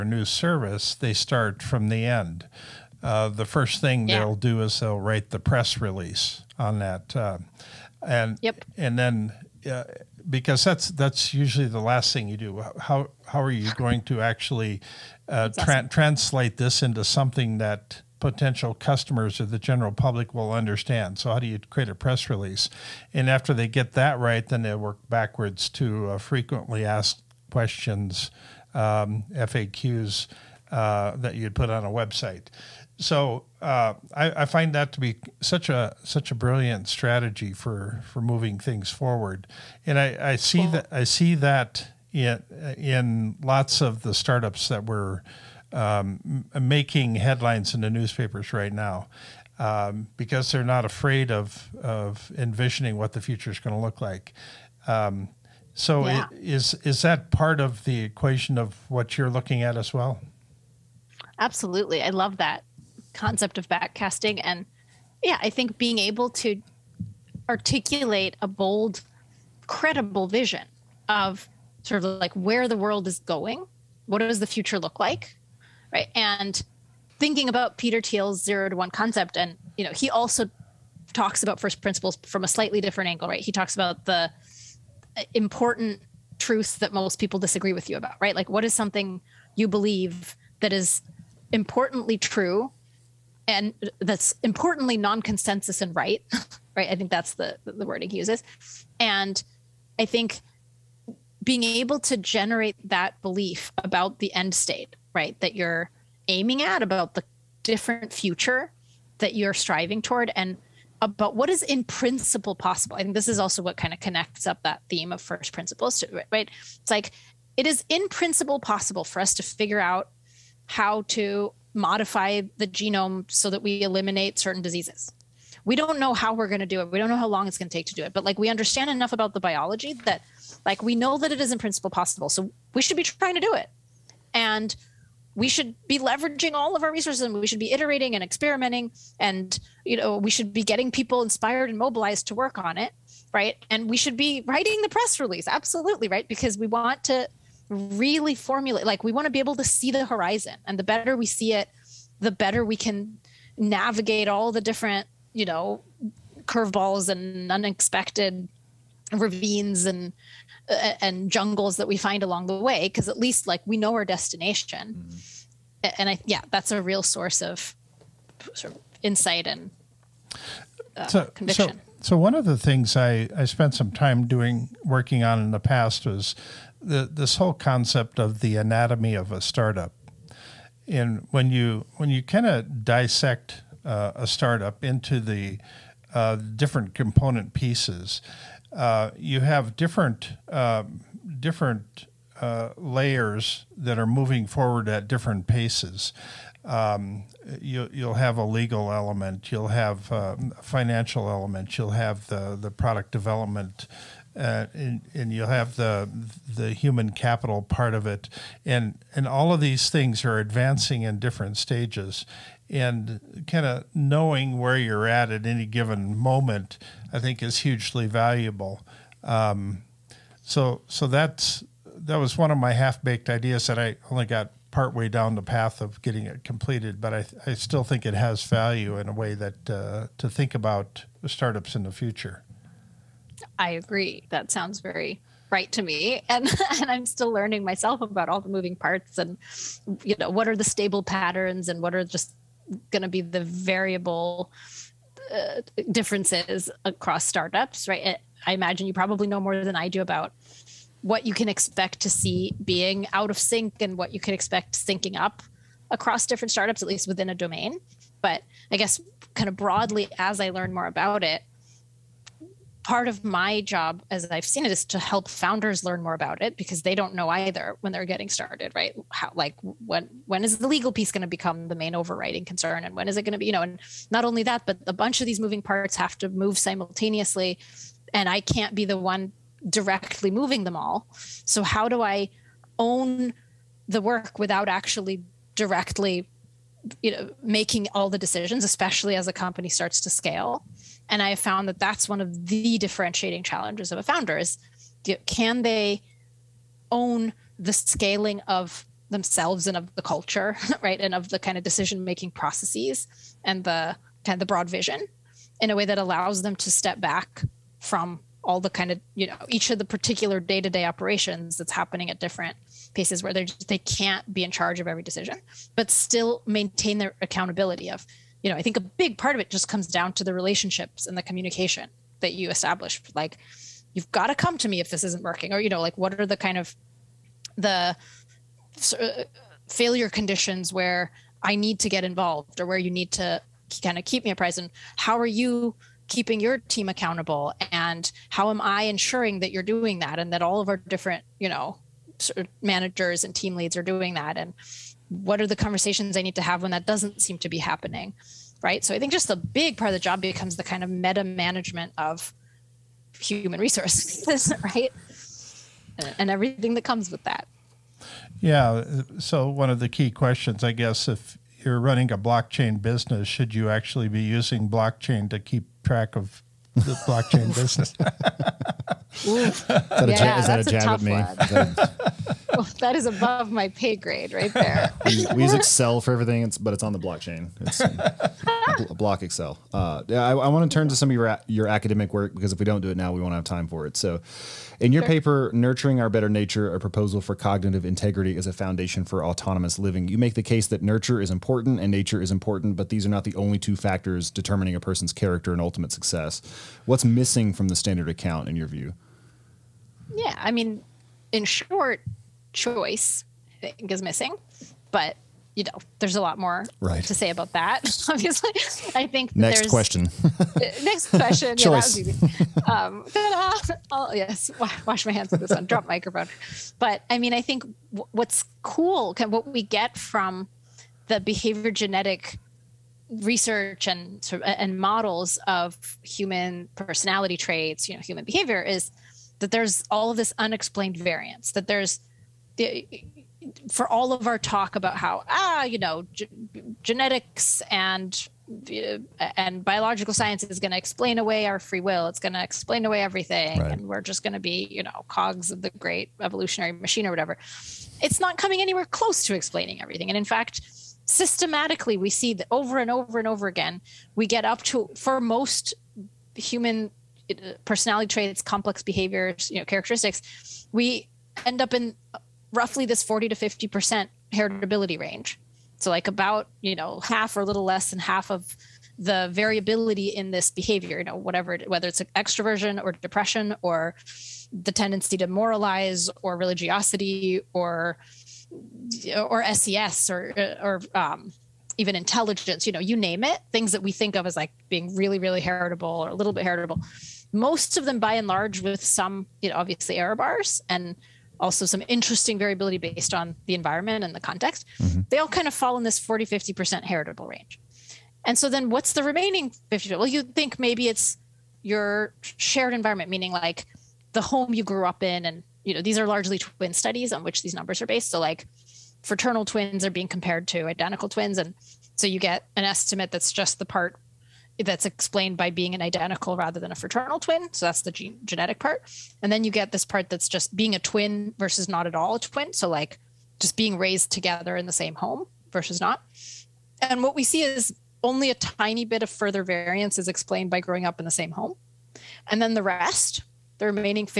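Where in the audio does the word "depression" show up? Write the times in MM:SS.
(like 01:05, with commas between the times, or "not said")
07:52.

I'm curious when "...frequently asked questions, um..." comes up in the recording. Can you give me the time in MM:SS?
00:26.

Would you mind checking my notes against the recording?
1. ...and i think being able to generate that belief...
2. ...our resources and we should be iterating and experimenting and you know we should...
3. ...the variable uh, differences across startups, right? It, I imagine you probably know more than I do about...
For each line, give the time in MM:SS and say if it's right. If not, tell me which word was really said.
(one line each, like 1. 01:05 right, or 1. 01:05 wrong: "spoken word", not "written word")
1. 01:38 right
2. 02:16 right
3. 04:03 right.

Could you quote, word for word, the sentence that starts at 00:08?
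and then uh, because that's that's usually the last thing you do.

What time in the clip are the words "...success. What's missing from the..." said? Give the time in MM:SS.
06:35.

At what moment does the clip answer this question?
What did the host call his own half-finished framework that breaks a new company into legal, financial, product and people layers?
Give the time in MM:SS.
02:58.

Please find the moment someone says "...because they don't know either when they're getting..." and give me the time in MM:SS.
04:26.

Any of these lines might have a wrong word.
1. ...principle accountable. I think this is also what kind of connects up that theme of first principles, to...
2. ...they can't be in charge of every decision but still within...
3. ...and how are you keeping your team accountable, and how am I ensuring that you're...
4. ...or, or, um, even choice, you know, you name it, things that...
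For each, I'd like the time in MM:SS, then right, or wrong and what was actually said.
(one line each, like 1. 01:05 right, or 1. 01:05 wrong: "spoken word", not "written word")
1. 01:51 wrong: "possible", not "accountable"
2. 05:13 wrong: "maintain", not "within"
3. 05:34 right
4. 08:00 wrong: "intelligence", not "choice".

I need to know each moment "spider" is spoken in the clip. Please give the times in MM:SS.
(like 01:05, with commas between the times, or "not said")
not said.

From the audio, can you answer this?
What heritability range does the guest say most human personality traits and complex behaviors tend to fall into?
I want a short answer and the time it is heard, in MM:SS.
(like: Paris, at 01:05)
40 to 50%, at 07:43.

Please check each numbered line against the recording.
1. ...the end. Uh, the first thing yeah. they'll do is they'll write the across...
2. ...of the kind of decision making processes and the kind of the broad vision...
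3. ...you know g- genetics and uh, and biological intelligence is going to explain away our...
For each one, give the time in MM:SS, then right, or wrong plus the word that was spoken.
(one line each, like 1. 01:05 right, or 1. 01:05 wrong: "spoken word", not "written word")
1. 00:01 wrong: "press", not "across"
2. 05:01 right
3. 07:15 wrong: "science", not "intelligence".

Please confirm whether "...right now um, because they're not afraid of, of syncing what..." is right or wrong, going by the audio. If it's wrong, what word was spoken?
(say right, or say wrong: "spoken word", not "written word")
wrong: "envisioning", not "syncing".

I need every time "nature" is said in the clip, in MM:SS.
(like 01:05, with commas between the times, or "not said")
06:26, 06:31.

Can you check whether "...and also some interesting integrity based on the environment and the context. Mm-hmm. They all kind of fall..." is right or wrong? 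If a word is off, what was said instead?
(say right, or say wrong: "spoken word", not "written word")
wrong: "variability", not "integrity".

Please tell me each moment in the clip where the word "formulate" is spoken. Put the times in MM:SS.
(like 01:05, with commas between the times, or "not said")
02:28.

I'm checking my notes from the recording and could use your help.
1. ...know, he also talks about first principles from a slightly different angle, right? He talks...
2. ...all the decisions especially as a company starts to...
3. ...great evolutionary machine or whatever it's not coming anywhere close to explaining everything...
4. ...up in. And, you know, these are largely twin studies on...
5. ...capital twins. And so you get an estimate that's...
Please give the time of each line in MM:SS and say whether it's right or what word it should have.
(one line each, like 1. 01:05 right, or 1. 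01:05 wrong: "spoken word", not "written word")
1. 01:19 right
2. 04:47 right
3. 07:25 right
4. 08:24 right
5. 08:30 wrong: "identical", not "capital".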